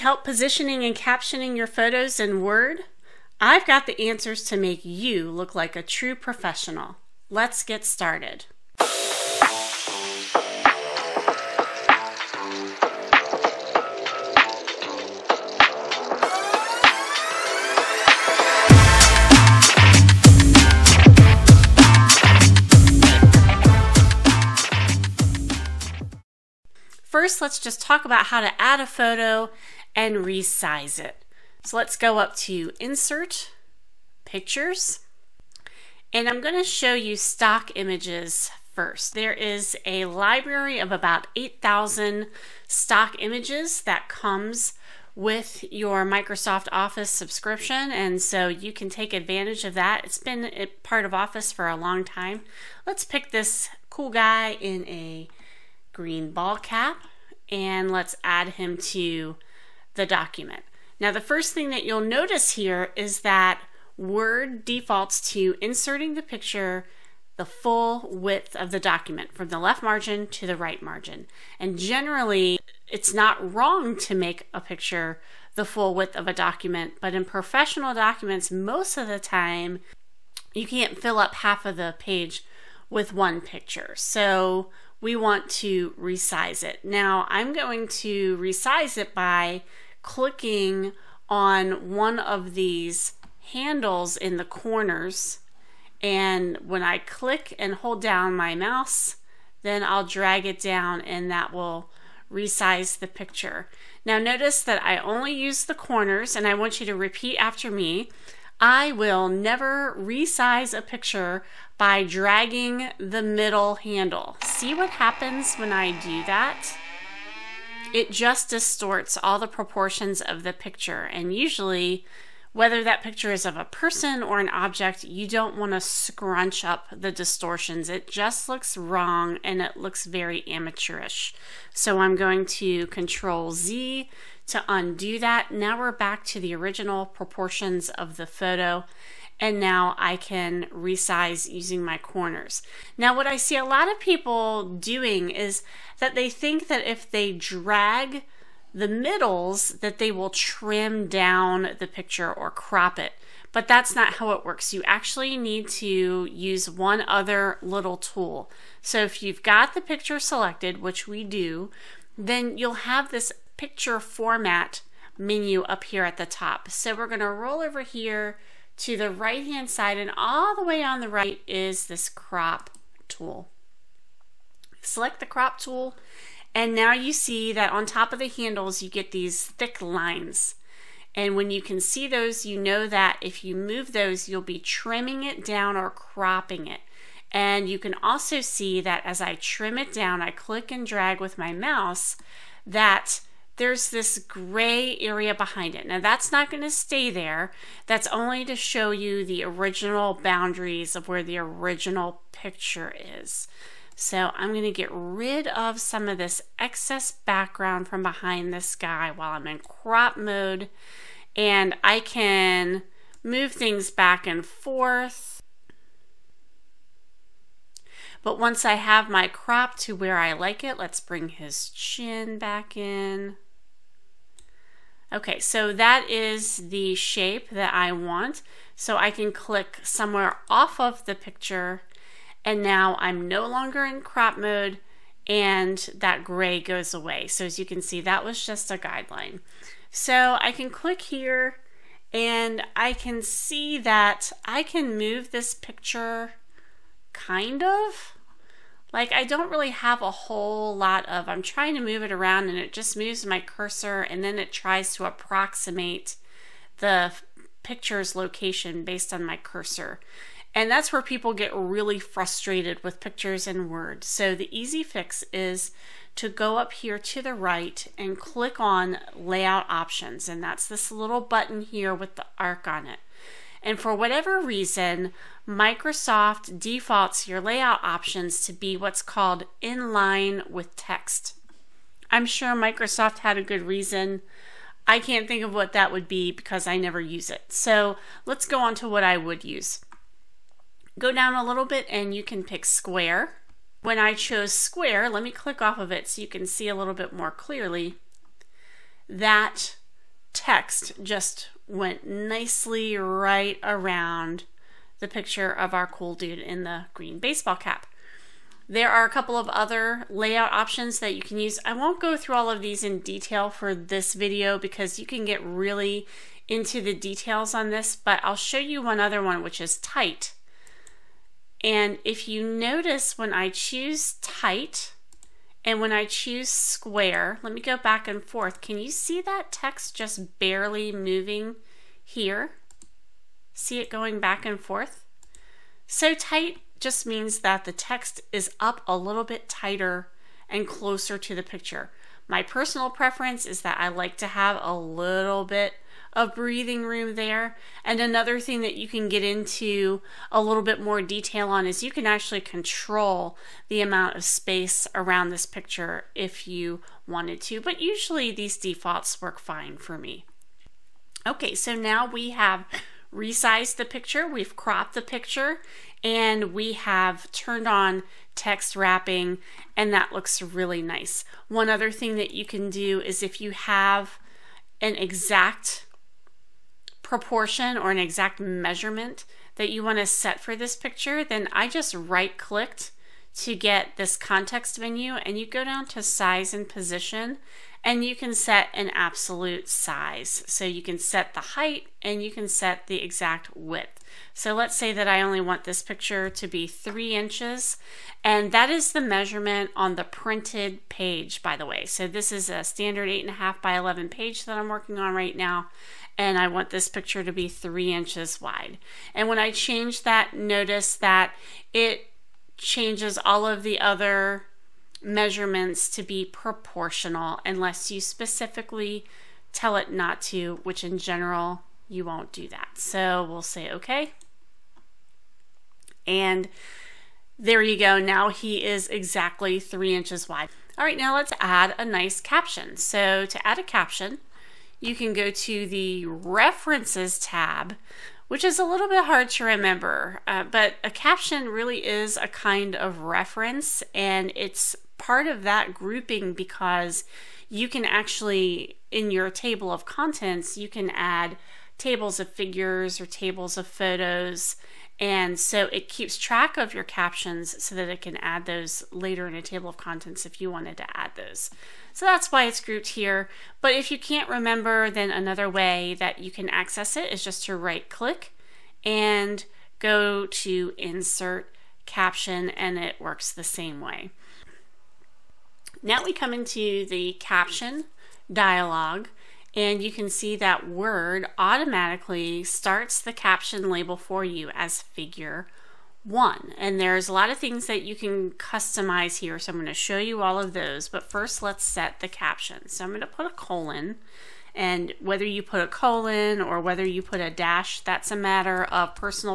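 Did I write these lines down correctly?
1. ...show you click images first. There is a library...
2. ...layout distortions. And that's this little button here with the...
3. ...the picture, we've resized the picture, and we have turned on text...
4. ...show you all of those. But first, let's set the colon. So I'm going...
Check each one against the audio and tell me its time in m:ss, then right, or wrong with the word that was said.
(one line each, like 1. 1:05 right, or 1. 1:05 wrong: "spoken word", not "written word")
1. 0:36 wrong: "stock", not "click"
2. 4:29 wrong: "options", not "distortions"
3. 6:03 wrong: "cropped", not "resized"
4. 8:09 wrong: "caption", not "colon".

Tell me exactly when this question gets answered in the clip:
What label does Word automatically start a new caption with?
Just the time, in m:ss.
8:04.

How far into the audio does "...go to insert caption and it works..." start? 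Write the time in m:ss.
7:49.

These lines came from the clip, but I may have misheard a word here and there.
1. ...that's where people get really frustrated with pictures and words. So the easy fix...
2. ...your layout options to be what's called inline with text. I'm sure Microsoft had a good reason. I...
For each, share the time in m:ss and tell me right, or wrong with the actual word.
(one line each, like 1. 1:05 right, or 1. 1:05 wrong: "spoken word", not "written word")
1. 4:20 right
2. 4:37 right.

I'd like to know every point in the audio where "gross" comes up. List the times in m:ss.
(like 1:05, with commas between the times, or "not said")
not said.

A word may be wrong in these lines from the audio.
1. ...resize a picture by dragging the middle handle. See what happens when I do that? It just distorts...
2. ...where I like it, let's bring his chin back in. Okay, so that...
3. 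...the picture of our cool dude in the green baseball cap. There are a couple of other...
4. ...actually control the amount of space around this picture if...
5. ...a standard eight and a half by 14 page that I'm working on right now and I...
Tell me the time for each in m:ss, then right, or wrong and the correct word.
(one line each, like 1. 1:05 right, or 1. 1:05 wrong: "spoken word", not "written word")
1. 1:49 right
2. 3:39 right
3. 5:04 right
4. 5:52 right
5. 6:42 wrong: "11", not "14".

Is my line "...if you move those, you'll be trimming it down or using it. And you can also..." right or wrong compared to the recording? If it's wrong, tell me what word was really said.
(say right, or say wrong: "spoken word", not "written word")
wrong: "cropping", not "using".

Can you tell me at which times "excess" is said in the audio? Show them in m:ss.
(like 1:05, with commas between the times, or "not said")
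3:26.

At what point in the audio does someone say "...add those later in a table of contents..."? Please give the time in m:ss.
7:38.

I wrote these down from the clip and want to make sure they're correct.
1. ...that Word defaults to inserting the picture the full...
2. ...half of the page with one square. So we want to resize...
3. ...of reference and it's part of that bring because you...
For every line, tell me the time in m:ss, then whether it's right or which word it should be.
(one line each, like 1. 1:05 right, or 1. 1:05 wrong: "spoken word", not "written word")
1. 1:03 right
2. 1:21 wrong: "picture", not "square"
3. 7:22 wrong: "grouping", not "bring".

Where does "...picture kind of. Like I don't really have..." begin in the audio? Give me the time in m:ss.
4:05.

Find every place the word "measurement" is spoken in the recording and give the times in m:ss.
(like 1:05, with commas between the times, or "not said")
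6:18, 6:39, 6:55.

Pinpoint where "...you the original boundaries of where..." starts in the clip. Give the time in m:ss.
3:18.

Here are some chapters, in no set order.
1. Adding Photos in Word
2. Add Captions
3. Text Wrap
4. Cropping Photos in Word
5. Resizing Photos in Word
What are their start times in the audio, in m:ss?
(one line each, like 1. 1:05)
1. 0:26
2. 7:09
3. 3:59
4. 2:46
5. 1:24.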